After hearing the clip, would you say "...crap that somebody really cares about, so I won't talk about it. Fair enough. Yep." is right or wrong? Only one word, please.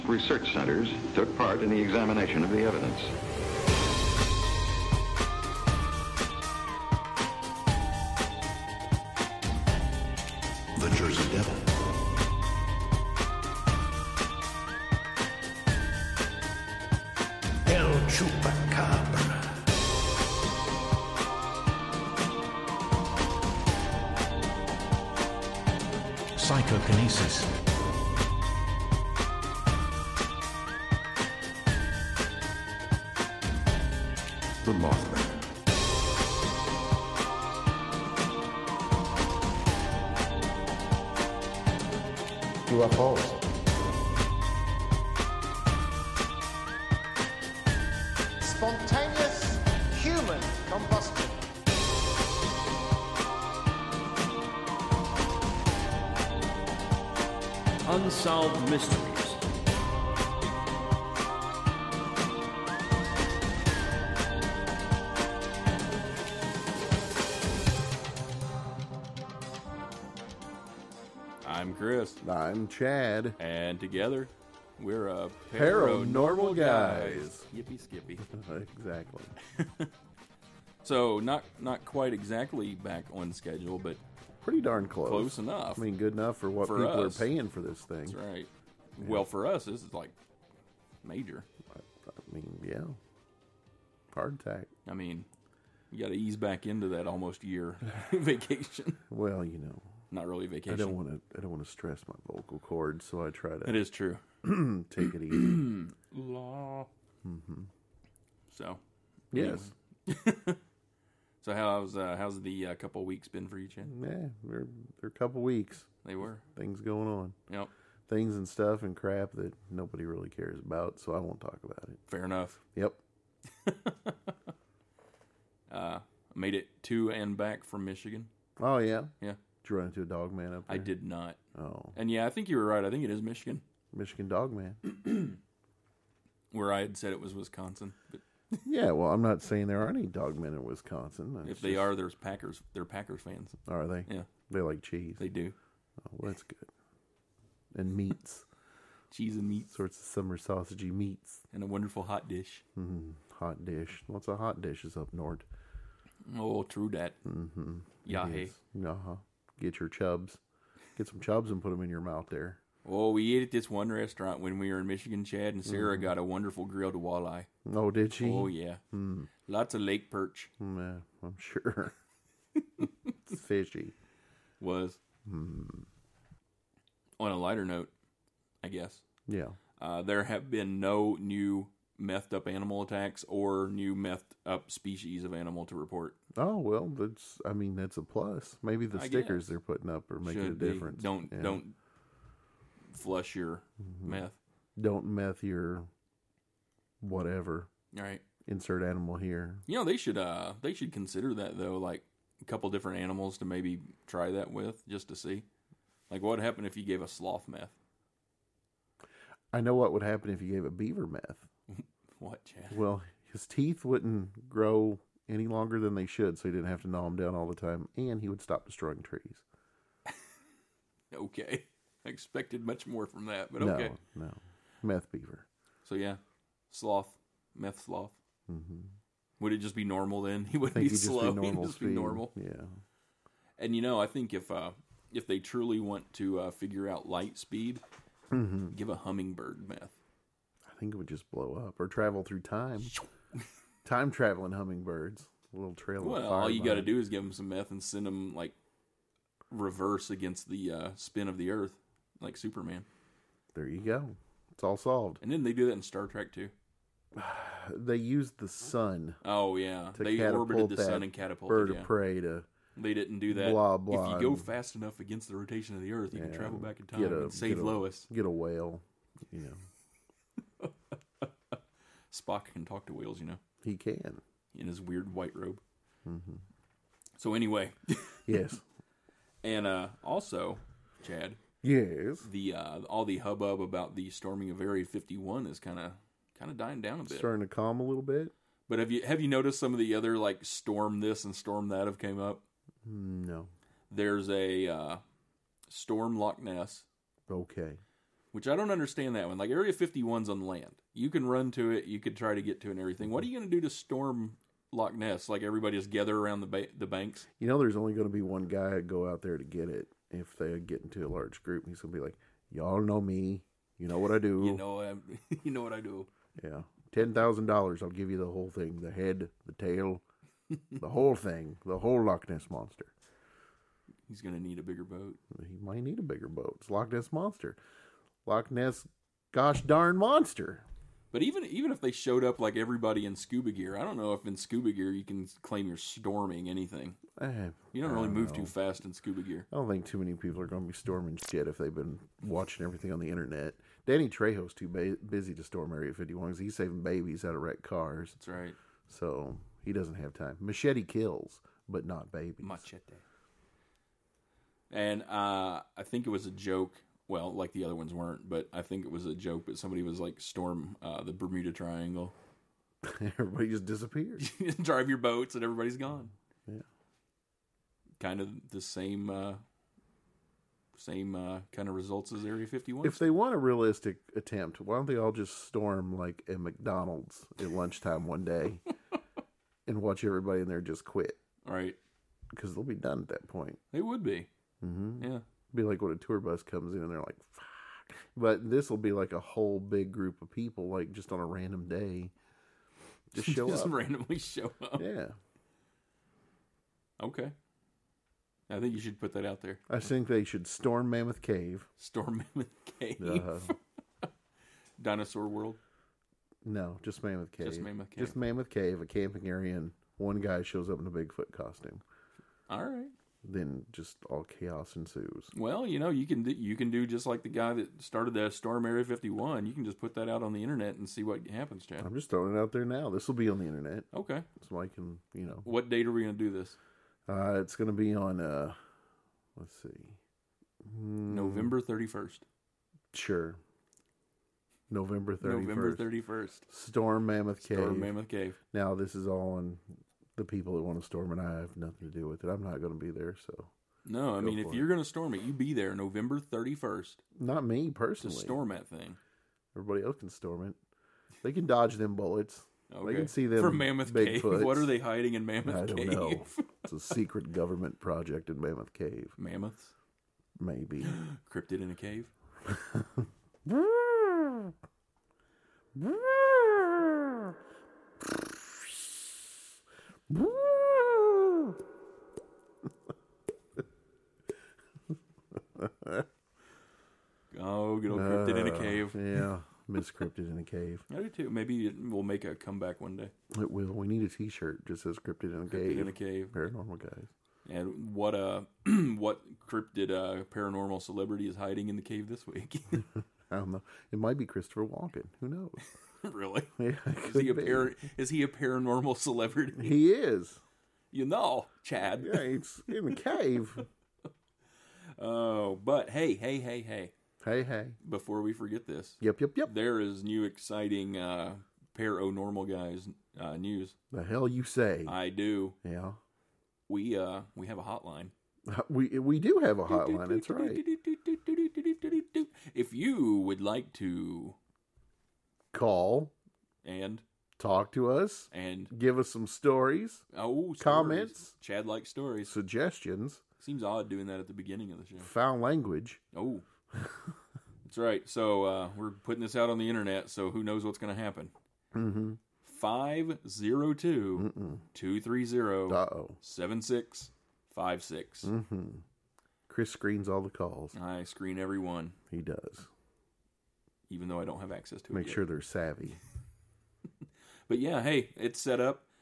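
wrong.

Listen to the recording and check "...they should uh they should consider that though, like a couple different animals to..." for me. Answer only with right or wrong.
right.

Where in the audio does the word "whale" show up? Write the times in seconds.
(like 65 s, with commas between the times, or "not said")
268 s, 272 s.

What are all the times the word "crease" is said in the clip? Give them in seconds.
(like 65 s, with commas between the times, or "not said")
not said.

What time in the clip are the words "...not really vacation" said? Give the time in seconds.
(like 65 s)
100 s.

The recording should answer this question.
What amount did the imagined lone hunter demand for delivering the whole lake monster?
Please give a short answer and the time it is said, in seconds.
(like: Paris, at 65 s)
$10,000, at 316 s.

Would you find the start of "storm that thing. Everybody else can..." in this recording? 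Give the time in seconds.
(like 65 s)
448 s.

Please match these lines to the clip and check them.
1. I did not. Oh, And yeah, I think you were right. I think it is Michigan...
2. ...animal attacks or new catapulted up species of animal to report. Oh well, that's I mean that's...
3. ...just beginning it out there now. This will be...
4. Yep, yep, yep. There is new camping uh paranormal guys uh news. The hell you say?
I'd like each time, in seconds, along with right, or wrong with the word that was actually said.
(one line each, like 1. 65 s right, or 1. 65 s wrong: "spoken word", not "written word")
1. 130 s right
2. 182 s wrong: "methed", not "catapulted"
3. 421 s wrong: "throwing", not "beginning"
4. 509 s wrong: "exciting", not "camping".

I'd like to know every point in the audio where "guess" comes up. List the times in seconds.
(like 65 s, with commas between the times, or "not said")
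178 s, 189 s.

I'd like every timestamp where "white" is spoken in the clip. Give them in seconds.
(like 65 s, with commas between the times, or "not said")
275 s.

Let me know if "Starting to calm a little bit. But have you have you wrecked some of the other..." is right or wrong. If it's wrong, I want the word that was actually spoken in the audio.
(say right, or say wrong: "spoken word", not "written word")
wrong: "noticed", not "wrecked".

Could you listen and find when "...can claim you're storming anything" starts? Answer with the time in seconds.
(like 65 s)
335 s.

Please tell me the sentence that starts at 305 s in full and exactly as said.
Like everybody just gather around the ba- the banks?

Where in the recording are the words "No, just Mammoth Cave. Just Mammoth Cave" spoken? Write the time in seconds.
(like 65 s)
406 s.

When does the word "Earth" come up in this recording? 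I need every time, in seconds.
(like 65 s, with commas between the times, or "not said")
251 s, 265 s.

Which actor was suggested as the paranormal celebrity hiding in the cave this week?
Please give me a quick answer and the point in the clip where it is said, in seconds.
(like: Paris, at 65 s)
Christopher Walken, at 494 s.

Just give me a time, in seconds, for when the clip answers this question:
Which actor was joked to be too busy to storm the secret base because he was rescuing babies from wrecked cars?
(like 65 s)
343 s.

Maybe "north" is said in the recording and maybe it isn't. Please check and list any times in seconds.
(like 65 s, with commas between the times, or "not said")
155 s.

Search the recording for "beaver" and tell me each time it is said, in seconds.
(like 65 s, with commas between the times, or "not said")
210 s, 225 s.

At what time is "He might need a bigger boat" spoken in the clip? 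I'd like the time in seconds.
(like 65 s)
325 s.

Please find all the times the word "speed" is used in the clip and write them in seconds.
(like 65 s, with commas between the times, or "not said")
231 s, 237 s.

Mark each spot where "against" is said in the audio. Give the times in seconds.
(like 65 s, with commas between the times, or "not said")
250 s, 264 s.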